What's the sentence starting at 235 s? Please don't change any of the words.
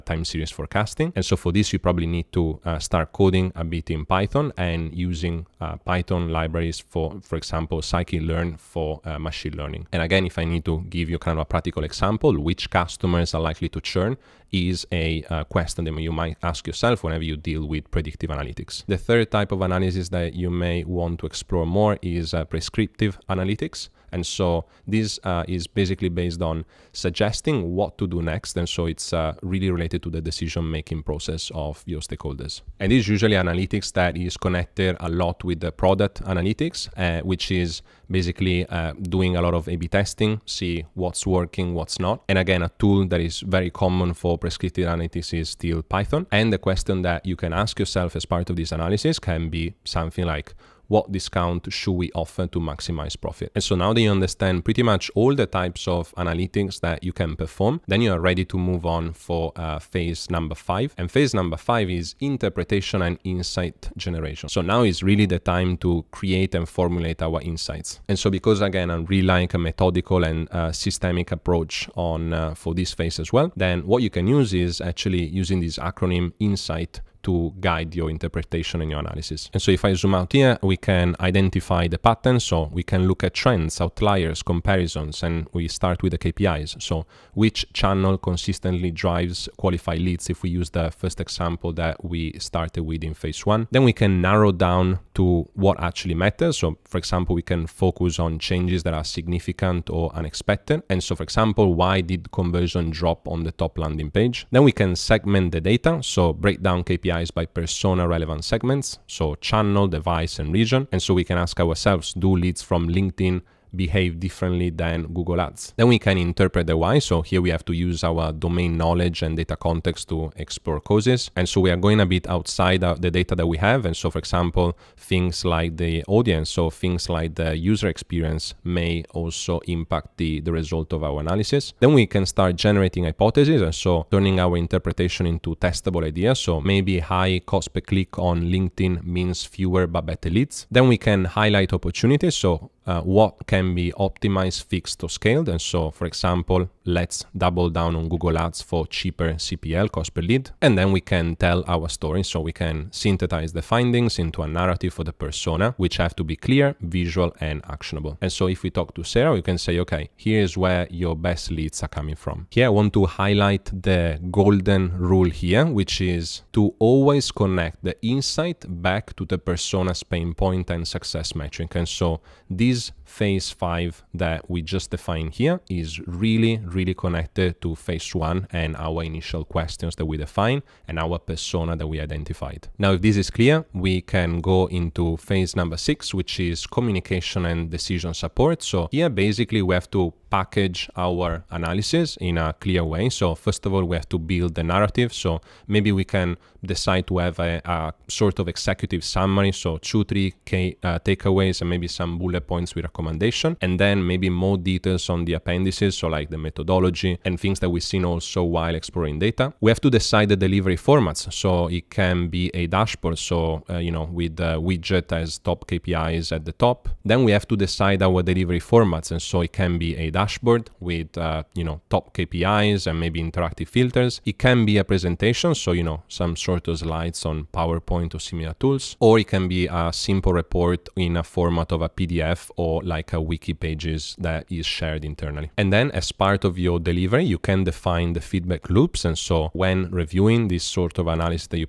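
And then as part of your delivery, you can define the feedback loops.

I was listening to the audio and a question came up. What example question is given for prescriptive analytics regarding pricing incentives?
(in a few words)
What discount should we offer to maximize profit.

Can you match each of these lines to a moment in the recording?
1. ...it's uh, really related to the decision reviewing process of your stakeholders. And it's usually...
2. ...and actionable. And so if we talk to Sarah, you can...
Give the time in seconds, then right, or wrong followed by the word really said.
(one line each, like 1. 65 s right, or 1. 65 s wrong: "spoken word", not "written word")
1. 28 s wrong: "making", not "reviewing"
2. 157 s right.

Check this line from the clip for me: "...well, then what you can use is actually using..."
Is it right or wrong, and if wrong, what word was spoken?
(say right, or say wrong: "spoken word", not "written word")
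right.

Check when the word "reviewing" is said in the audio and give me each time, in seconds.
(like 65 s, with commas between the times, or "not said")
239 s.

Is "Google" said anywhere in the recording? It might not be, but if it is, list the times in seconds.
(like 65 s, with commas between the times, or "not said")
115 s, 148 s.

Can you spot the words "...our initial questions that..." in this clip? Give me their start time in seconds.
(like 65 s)
178 s.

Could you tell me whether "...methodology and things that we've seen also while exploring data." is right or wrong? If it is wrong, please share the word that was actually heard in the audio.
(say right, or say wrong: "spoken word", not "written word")
right.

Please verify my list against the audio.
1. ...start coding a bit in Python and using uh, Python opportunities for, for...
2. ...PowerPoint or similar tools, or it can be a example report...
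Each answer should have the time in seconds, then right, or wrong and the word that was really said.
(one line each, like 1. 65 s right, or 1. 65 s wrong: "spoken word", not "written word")
1. 2 s wrong: "libraries", not "opportunities"
2. 227 s wrong: "simple", not "example".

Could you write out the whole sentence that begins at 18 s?
The third type of analysis that you may want to explore more is uh, prescriptive analytics.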